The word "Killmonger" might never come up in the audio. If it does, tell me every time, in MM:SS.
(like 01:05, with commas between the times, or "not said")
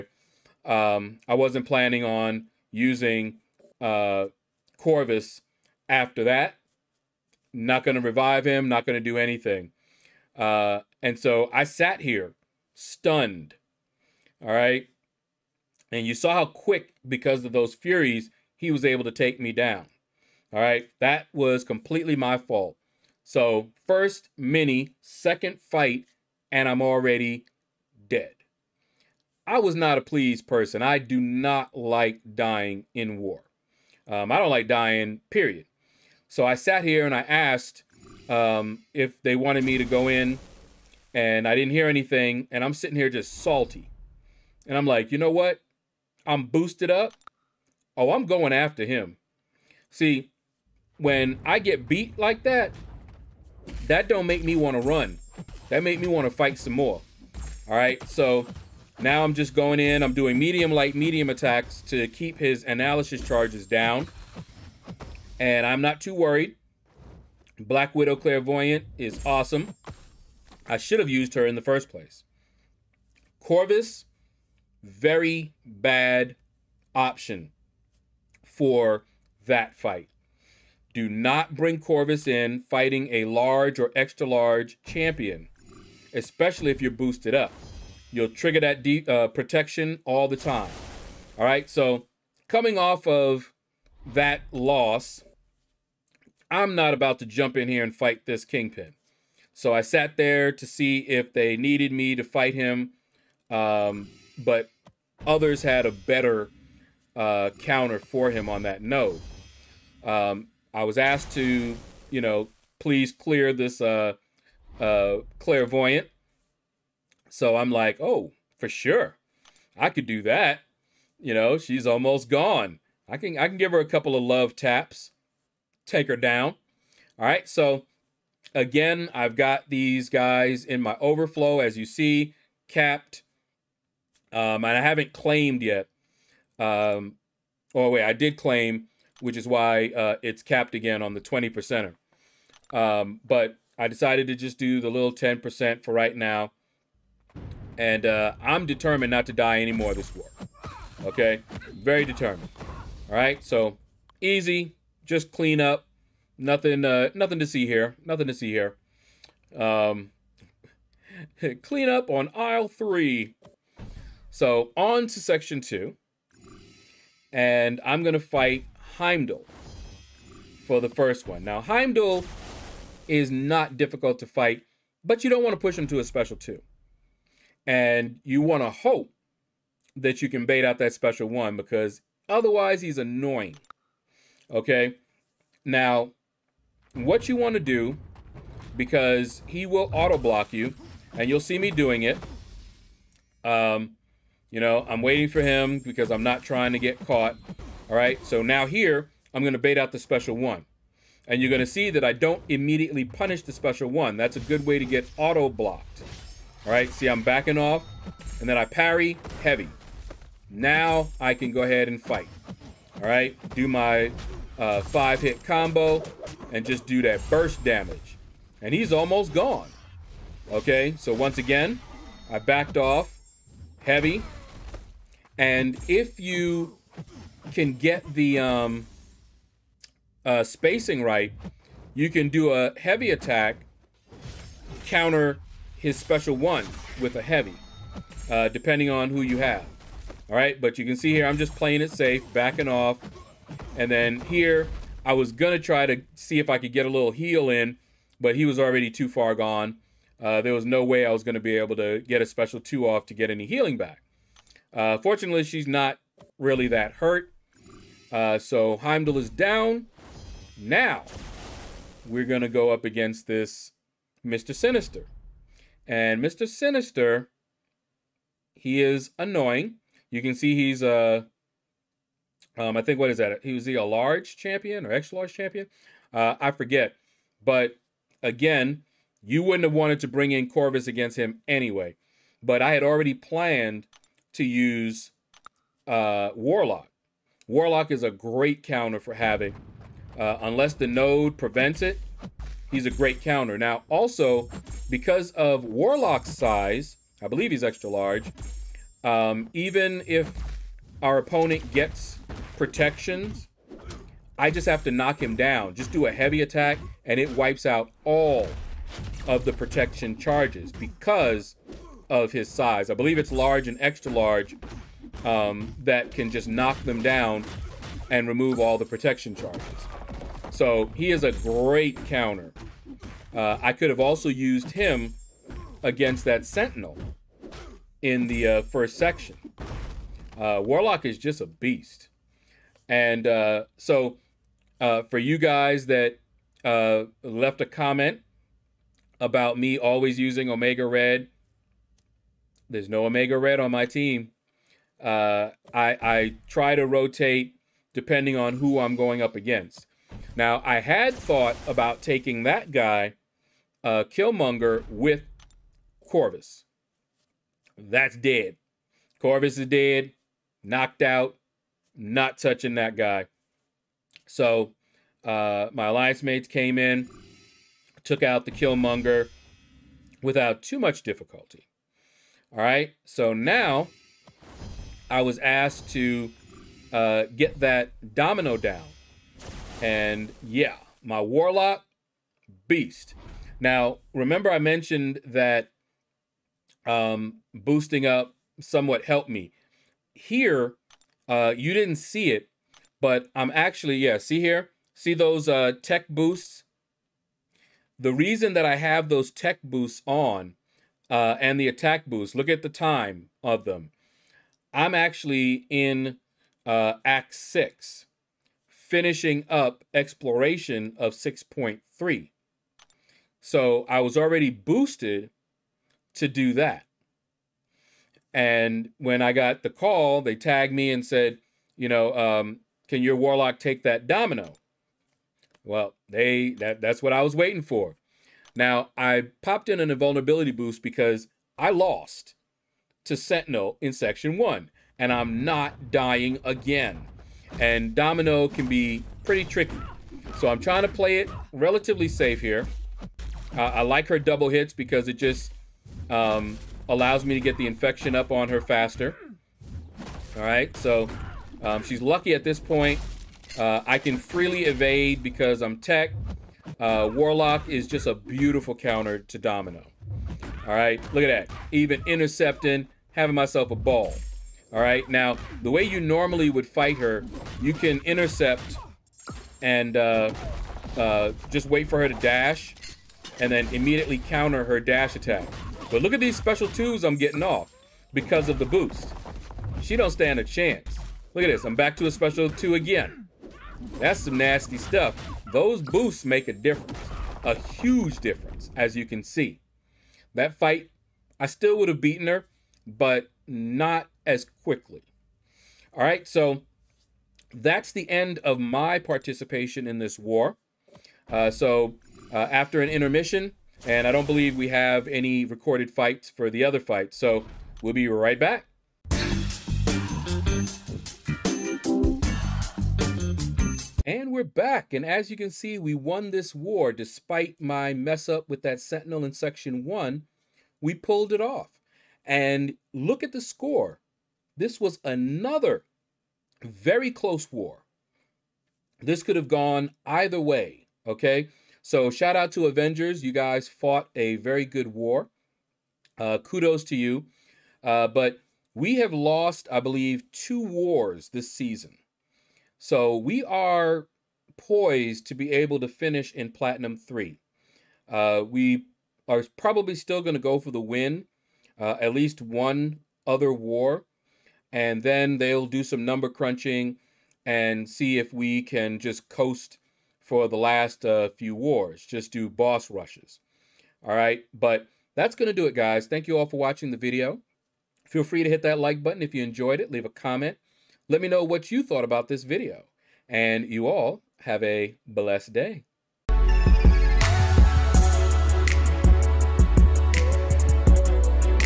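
05:54, 06:08.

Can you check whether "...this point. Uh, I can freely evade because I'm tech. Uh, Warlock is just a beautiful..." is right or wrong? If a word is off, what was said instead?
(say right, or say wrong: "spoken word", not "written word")
right.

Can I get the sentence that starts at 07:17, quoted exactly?
And Domino can be pretty tricky.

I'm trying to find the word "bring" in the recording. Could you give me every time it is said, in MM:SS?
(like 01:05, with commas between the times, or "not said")
01:21, 04:40.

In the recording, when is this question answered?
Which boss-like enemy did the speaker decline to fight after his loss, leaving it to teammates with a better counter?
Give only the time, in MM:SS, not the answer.
01:38.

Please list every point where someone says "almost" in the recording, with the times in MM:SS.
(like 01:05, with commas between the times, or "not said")
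02:01, 03:38.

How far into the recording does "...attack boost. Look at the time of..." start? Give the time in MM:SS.
06:41.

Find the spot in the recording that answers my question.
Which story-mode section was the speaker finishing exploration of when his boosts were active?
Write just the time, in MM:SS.
06:51.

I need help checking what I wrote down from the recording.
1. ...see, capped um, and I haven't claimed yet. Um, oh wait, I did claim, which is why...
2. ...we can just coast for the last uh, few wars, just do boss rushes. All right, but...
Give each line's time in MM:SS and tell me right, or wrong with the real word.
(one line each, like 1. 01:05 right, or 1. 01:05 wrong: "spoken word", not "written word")
1. 02:11 right
2. 09:18 right.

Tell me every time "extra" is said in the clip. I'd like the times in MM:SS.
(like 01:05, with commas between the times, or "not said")
01:23, 04:34, 04:57, 05:13.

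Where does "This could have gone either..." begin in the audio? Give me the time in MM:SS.
08:48.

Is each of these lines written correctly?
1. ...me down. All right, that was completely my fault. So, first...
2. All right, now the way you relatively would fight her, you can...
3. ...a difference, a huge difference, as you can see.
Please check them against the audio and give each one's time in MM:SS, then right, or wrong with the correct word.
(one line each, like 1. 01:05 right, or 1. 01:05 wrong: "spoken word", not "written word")
1. 00:19 right
2. 07:44 wrong: "normally", not "relatively"
3. 08:06 right.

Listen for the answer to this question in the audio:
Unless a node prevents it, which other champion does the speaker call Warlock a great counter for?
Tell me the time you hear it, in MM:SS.
04:49.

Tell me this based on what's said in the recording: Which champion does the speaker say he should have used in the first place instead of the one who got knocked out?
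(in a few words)
Black Widow Clairvoyant.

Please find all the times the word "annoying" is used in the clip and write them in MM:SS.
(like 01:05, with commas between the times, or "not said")
03:02, 04:29.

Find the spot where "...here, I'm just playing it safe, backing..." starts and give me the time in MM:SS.
04:01.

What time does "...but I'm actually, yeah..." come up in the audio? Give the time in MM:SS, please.
06:32.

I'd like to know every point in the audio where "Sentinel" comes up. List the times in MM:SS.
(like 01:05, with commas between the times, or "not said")
05:26, 07:13, 08:38.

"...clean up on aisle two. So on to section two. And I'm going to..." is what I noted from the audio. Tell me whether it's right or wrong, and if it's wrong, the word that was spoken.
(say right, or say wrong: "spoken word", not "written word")
wrong: "three", not "two".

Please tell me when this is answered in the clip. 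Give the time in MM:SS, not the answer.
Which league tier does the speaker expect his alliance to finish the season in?
09:06.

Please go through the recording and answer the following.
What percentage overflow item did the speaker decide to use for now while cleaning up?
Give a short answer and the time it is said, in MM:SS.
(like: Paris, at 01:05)
10 percent, at 02:25.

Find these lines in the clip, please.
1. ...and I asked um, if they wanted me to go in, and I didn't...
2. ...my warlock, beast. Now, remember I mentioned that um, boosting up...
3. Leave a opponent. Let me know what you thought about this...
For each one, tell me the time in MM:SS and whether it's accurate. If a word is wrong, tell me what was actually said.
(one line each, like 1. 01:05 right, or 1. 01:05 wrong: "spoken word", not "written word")
1. 00:37 right
2. 06:21 right
3. 09:29 wrong: "comment", not "opponent".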